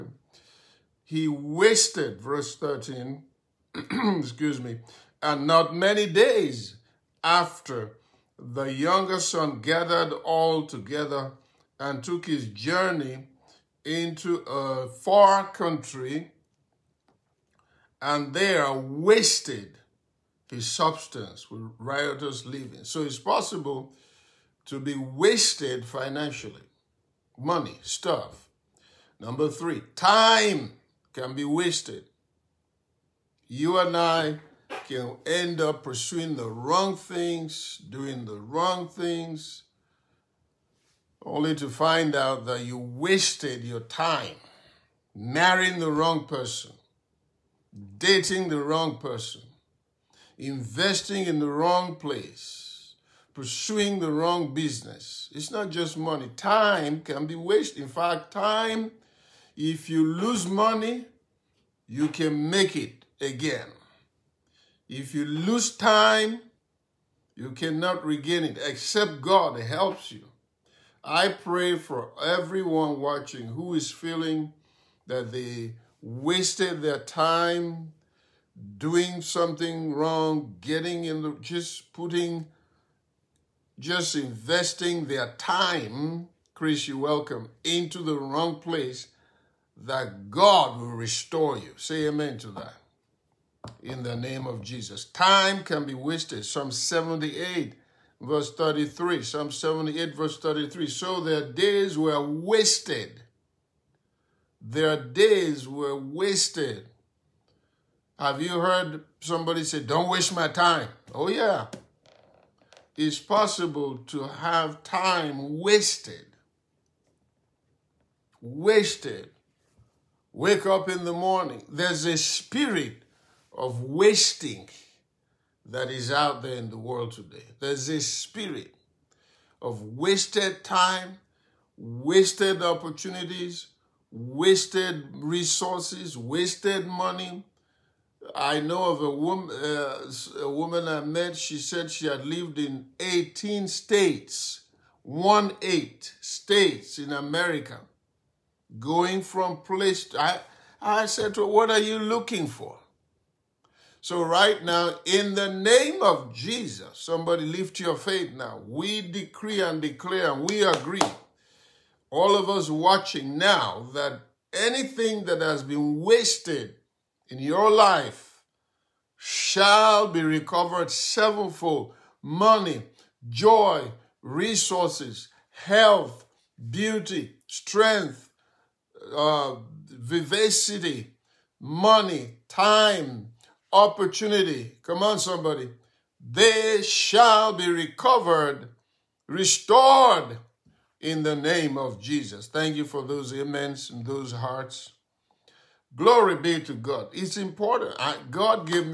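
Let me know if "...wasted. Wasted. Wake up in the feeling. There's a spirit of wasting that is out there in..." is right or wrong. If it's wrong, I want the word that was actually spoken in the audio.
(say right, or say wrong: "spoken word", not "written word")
wrong: "morning", not "feeling".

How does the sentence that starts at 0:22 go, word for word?
So it's possible to be wasted financially money, stuff.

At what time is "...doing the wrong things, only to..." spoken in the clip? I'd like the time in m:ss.
0:37.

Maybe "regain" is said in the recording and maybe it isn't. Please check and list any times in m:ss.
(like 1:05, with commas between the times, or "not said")
1:08.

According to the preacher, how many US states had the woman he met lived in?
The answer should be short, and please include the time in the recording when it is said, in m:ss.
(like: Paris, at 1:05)
18, at 2:22.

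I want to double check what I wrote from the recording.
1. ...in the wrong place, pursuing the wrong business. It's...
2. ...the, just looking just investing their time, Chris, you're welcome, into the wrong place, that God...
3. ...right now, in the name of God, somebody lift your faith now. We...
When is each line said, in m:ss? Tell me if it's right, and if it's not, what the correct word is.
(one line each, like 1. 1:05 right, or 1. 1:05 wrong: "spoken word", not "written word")
1. 0:51 right
2. 1:21 wrong: "putting", not "looking"
3. 2:34 wrong: "Jesus", not "God".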